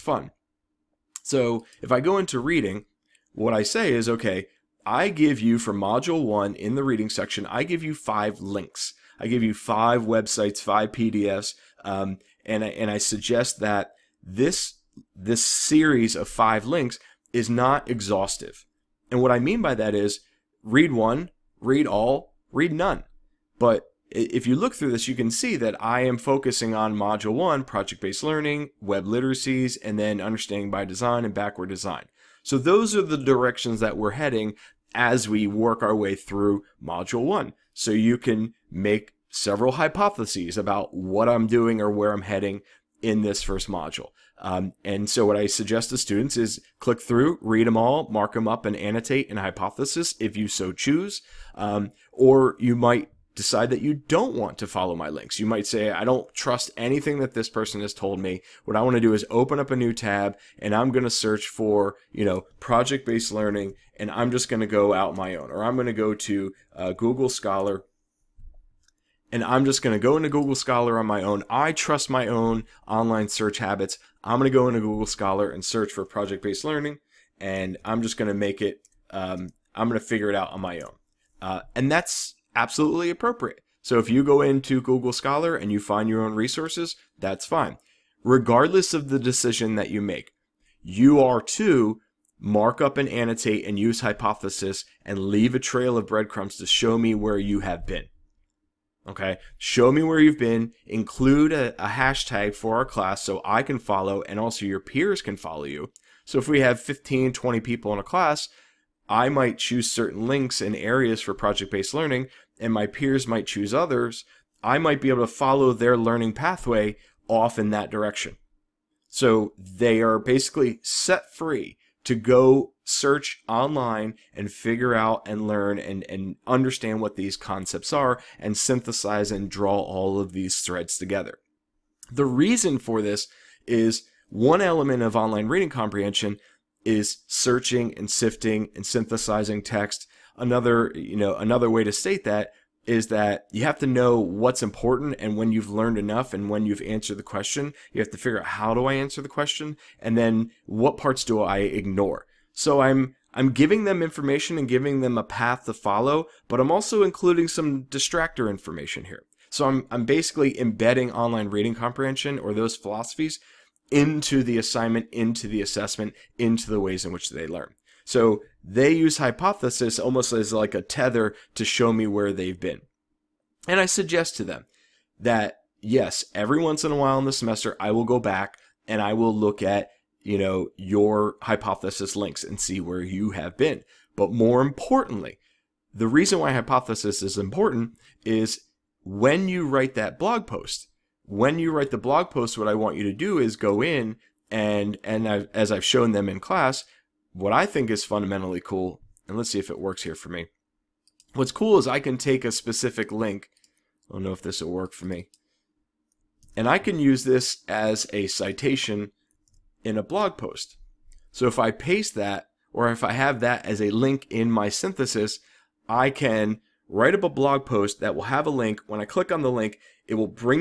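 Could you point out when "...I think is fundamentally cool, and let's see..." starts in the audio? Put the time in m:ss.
3:17.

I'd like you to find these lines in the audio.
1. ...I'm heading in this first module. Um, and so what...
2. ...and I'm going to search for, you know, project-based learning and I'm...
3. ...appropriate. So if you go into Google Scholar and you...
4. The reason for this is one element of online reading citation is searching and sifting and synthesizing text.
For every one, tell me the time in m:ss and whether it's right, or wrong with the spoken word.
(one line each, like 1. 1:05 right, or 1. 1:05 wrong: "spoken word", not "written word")
1. 0:42 right
2. 1:00 right
3. 1:23 right
4. 2:12 wrong: "comprehension", not "citation".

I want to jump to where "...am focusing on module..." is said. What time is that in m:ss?
0:26.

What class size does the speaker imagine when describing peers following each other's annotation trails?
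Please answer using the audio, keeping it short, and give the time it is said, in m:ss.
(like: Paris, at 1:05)
15 to 20 people, at 1:46.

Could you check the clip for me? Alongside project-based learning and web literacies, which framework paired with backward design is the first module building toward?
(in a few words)
Understanding by design.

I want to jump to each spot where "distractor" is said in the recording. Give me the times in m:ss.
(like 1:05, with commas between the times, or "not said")
2:37.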